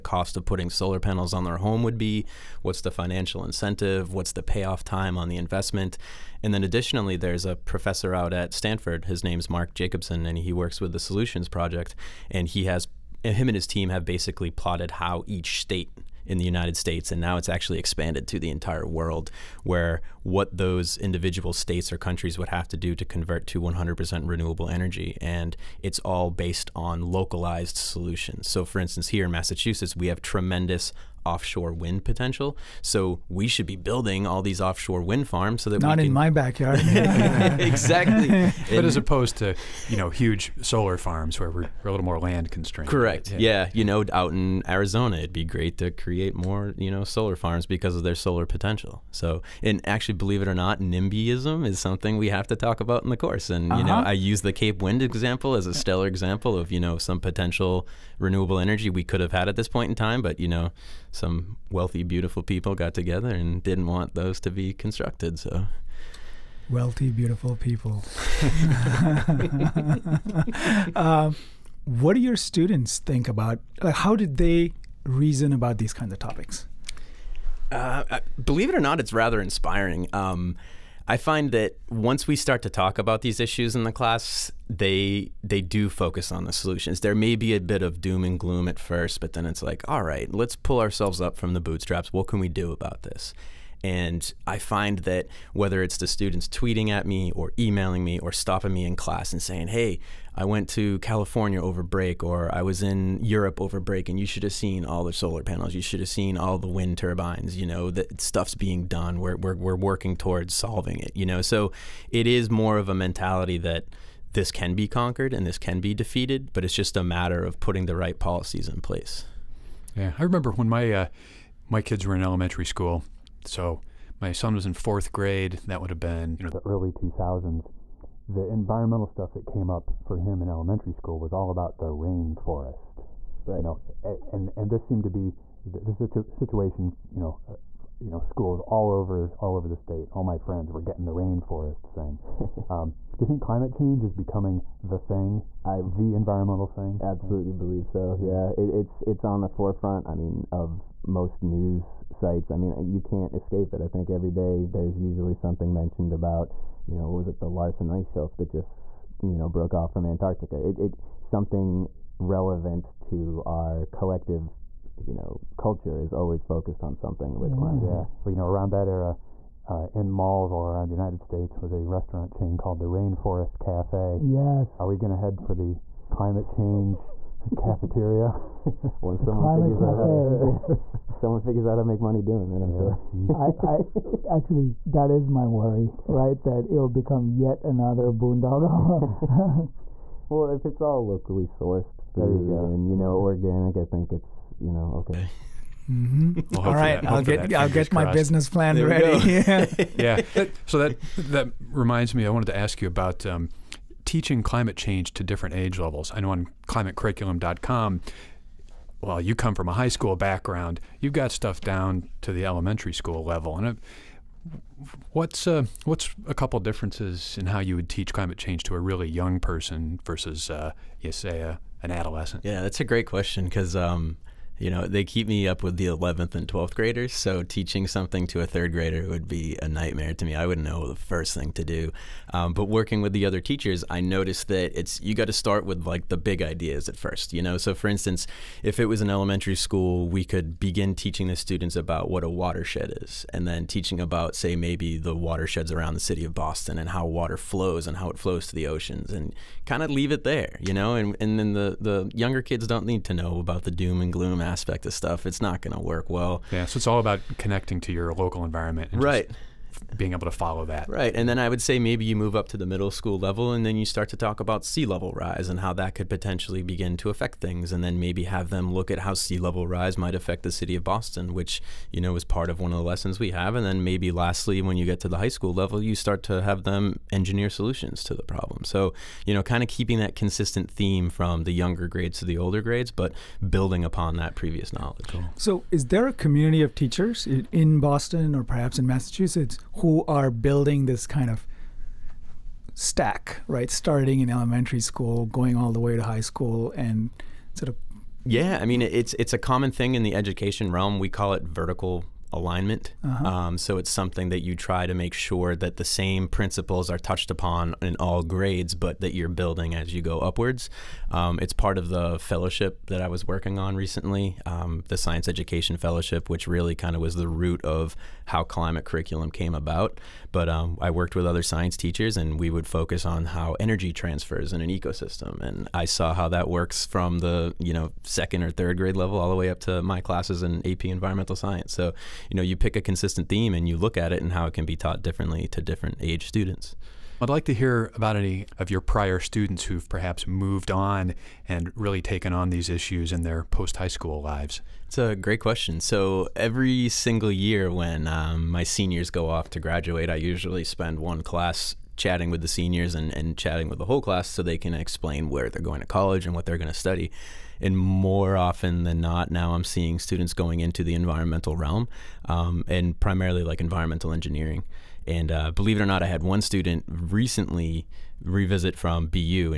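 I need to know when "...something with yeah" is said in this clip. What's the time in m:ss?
2:46.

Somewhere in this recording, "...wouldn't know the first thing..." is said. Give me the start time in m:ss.
3:50.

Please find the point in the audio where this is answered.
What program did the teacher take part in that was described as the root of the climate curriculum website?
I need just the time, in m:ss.
5:14.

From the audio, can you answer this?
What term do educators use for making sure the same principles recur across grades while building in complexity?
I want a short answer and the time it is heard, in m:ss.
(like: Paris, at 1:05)
vertical alignment, at 5:01.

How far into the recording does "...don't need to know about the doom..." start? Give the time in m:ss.
4:12.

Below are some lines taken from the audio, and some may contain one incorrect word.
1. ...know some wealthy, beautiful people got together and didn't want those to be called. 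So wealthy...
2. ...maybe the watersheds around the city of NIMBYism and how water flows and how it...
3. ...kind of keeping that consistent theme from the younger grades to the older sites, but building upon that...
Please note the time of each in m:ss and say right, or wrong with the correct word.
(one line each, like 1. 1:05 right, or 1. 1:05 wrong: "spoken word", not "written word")
1. 1:00 wrong: "constructed", not "called"
2. 4:04 wrong: "Boston", not "NIMBYism"
3. 4:39 wrong: "grades", not "sites".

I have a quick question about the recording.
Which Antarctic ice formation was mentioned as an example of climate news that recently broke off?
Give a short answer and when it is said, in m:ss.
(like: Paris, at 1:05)
Larsen ice shelf, at 2:37.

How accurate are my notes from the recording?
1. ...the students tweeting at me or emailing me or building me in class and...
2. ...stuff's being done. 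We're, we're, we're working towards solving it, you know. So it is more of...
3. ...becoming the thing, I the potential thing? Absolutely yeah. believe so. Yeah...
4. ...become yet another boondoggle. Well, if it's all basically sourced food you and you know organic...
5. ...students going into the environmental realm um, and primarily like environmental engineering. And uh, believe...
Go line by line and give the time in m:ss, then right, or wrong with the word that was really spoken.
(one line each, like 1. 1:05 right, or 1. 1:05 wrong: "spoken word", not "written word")
1. 1:35 wrong: "stopping", not "building"
2. 1:48 right
3. 2:24 wrong: "environmental", not "potential"
4. 3:06 wrong: "locally", not "basically"
5. 5:59 right.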